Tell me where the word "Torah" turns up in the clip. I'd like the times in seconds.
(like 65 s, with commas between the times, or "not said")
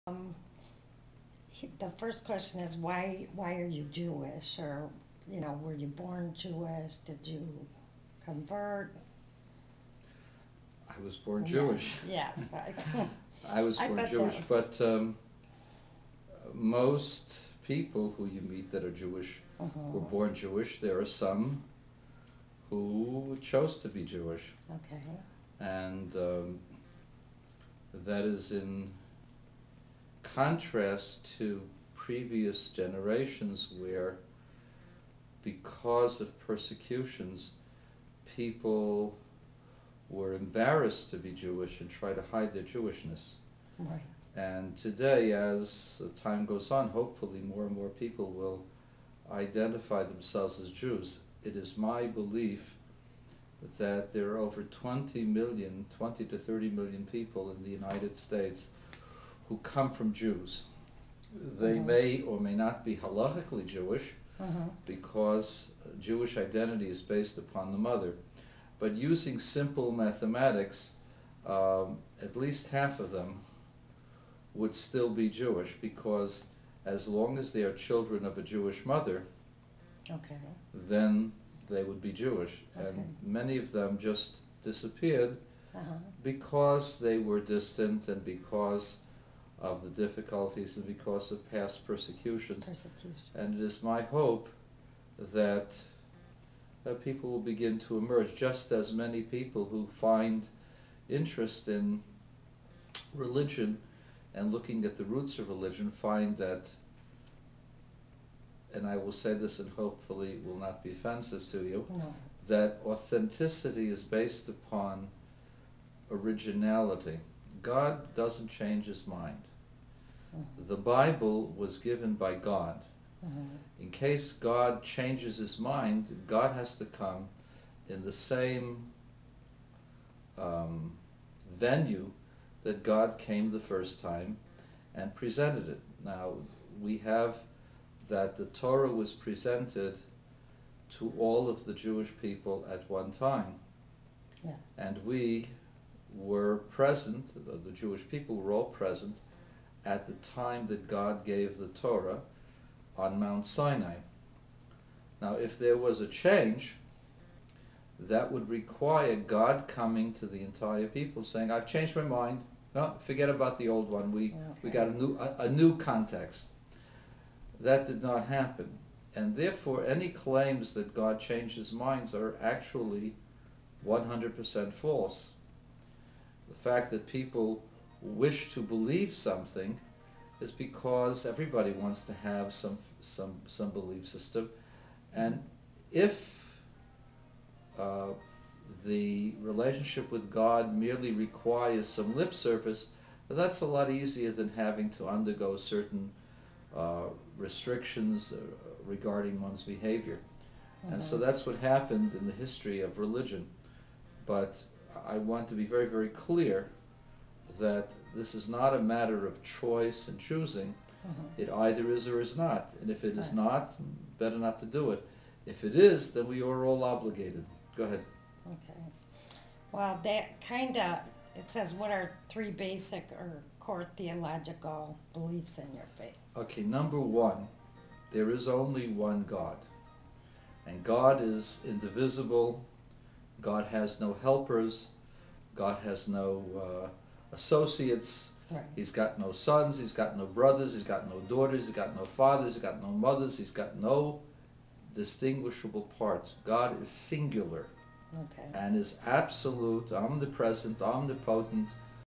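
138 s, 151 s.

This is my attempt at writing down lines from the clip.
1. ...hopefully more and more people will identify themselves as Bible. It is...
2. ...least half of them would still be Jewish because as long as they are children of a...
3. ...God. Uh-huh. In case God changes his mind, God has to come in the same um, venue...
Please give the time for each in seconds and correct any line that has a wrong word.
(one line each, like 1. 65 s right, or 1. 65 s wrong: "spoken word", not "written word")
1. 46 s wrong: "Jews", not "Bible"
2. 72 s right
3. 122 s right.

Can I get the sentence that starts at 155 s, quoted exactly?
Now, if there was a change, that would require God coming to the entire people saying, I've changed my mind.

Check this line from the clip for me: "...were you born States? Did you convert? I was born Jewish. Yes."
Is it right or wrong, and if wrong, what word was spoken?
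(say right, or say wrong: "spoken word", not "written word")
wrong: "Jewish", not "States".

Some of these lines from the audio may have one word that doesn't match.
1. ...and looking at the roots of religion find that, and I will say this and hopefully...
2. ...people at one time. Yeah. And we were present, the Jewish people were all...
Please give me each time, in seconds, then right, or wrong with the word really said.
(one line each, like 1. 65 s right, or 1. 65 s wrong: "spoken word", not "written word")
1. 104 s right
2. 142 s right.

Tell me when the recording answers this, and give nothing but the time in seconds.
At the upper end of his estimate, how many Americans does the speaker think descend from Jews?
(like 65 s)
55 s.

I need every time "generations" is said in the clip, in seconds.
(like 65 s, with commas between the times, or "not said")
32 s.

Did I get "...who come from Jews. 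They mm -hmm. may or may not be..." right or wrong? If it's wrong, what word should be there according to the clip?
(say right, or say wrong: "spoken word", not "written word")
right.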